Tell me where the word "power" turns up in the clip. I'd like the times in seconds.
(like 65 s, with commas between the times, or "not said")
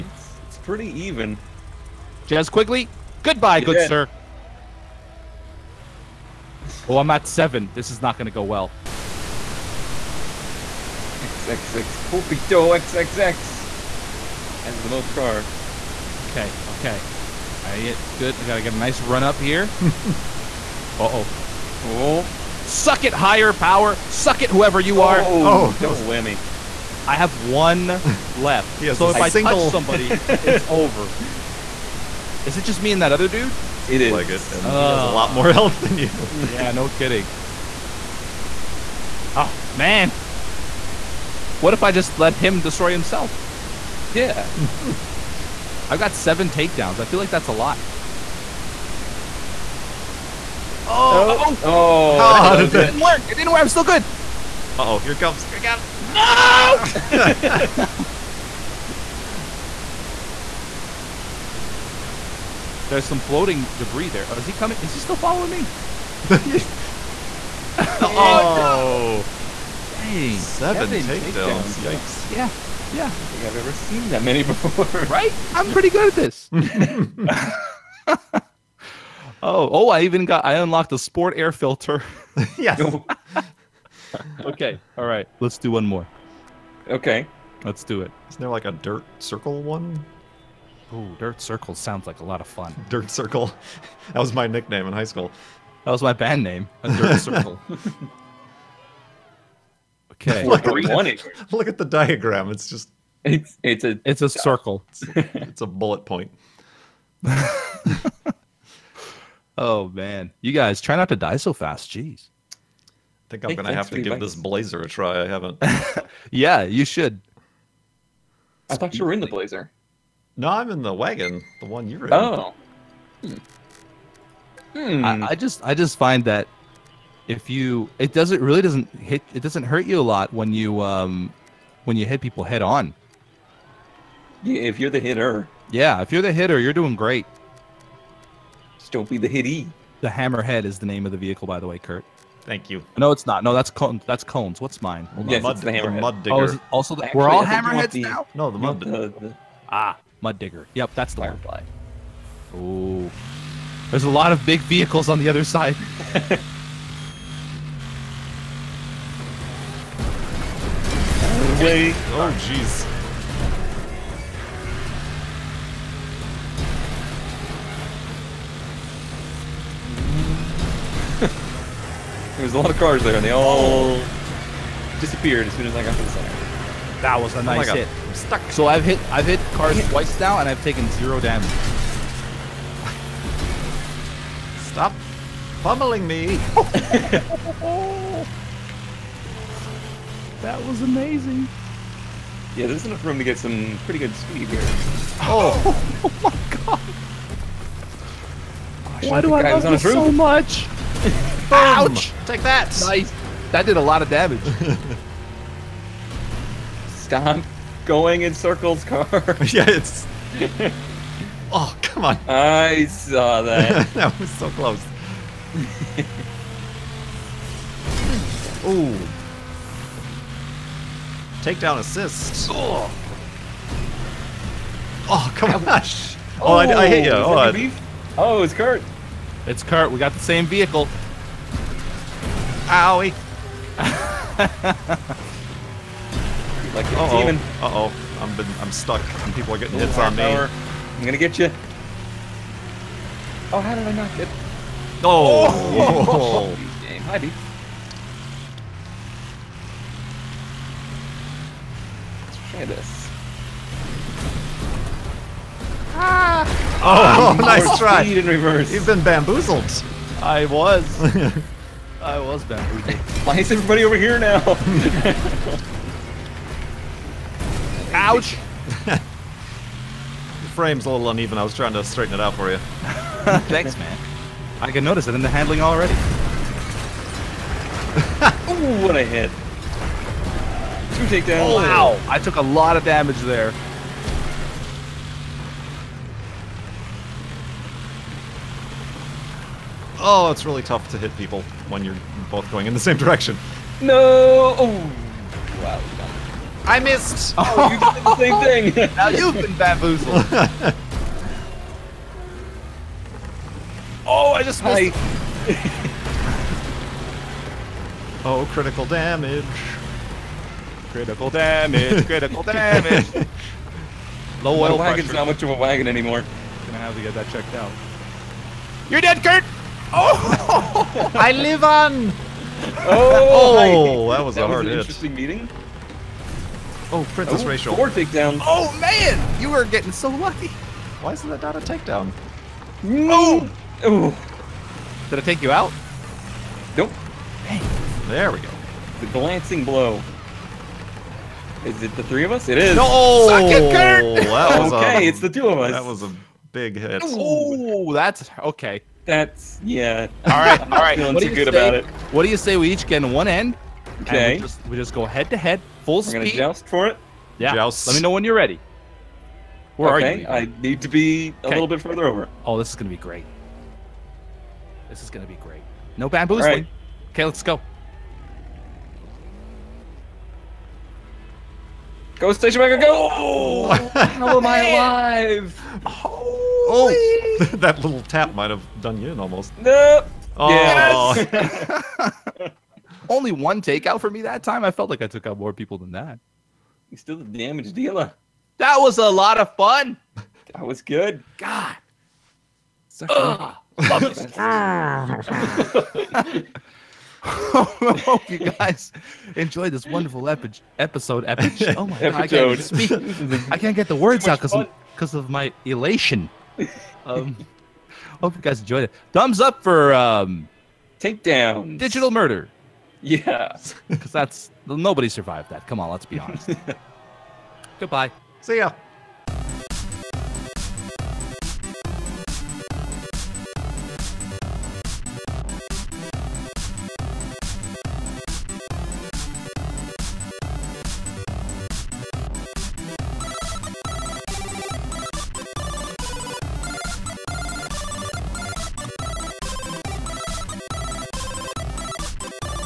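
23 s, 240 s.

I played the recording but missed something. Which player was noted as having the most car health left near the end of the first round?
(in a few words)
XXX Pulpito XXX.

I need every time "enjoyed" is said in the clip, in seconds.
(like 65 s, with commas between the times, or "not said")
399 s, 408 s.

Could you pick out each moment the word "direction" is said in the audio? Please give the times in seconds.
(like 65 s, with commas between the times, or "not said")
292 s.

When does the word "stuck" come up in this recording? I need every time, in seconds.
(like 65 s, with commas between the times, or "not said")
178 s, 238 s.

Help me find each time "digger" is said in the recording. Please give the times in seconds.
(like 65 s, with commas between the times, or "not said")
146 s, 150 s.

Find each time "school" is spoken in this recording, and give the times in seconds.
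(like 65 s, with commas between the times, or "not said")
95 s.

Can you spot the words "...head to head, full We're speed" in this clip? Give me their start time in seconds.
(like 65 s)
355 s.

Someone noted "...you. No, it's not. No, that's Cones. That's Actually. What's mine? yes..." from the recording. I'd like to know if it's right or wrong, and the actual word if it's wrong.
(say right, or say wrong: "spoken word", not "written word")
wrong: "Cones", not "Actually".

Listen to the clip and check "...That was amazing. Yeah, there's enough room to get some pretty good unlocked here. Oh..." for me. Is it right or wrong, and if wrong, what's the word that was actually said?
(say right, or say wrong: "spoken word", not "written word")
wrong: "speed", not "unlocked".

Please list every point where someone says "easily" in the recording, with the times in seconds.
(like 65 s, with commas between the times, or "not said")
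not said.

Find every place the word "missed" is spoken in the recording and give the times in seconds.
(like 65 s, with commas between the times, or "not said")
296 s, 304 s.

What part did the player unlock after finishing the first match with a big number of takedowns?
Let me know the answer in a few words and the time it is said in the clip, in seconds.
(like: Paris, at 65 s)
Sport air filter, at 80 s.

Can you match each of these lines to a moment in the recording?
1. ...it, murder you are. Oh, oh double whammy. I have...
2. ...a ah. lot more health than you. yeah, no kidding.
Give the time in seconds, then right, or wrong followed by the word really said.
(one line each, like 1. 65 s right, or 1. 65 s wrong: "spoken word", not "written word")
1. 24 s wrong: "whoever", not "murder"
2. 35 s right.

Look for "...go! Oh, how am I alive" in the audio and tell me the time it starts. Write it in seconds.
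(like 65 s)
372 s.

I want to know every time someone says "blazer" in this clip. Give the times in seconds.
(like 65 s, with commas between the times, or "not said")
114 s, 119 s.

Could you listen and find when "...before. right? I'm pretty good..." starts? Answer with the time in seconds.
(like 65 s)
74 s.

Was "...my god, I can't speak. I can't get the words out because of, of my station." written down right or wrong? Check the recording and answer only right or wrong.
wrong.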